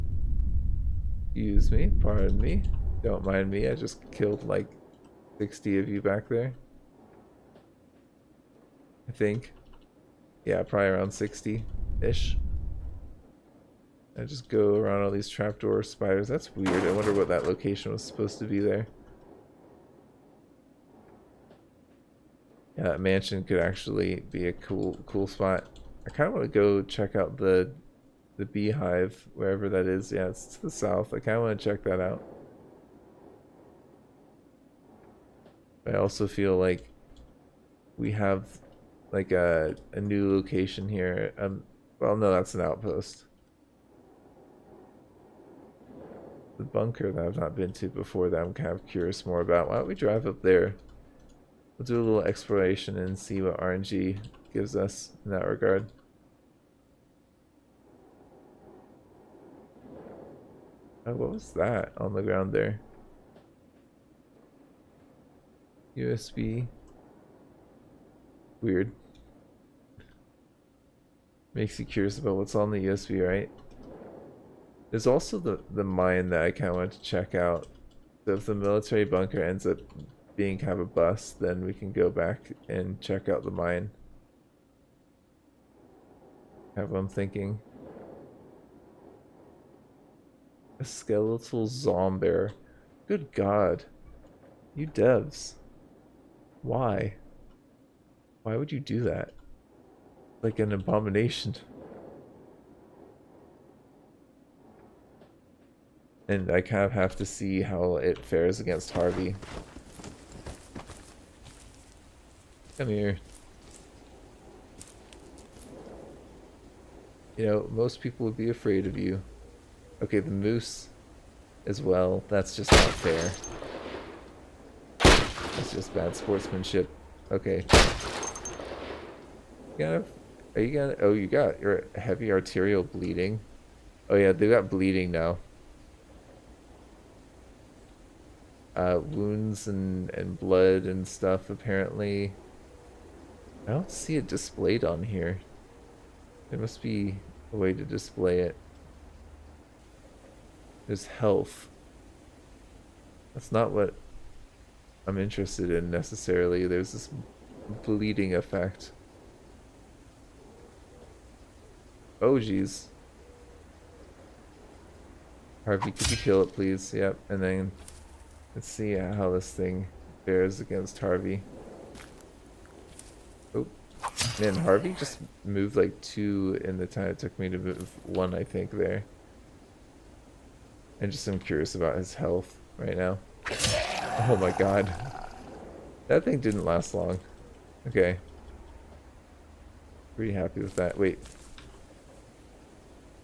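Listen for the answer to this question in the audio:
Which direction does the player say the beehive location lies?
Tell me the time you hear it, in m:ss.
0:30.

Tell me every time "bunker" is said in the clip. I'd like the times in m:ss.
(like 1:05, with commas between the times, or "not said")
0:46, 1:19.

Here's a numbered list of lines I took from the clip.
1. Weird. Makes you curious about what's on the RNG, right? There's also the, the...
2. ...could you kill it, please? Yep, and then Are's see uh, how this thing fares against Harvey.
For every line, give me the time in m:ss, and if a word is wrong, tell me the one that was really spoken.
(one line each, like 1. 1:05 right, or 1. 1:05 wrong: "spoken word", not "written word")
1. 1:08 wrong: "USB", not "RNG"
2. 2:45 wrong: "Let", not "Are".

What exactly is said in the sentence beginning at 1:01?
Oh, what was that on the ground there?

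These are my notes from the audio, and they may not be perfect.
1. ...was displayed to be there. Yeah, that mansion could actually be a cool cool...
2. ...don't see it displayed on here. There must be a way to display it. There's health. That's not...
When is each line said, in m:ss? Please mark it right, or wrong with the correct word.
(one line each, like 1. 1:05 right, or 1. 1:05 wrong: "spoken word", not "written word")
1. 0:17 wrong: "supposed", not "displayed"
2. 2:23 right.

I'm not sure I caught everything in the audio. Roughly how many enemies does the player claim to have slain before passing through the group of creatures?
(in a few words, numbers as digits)
60.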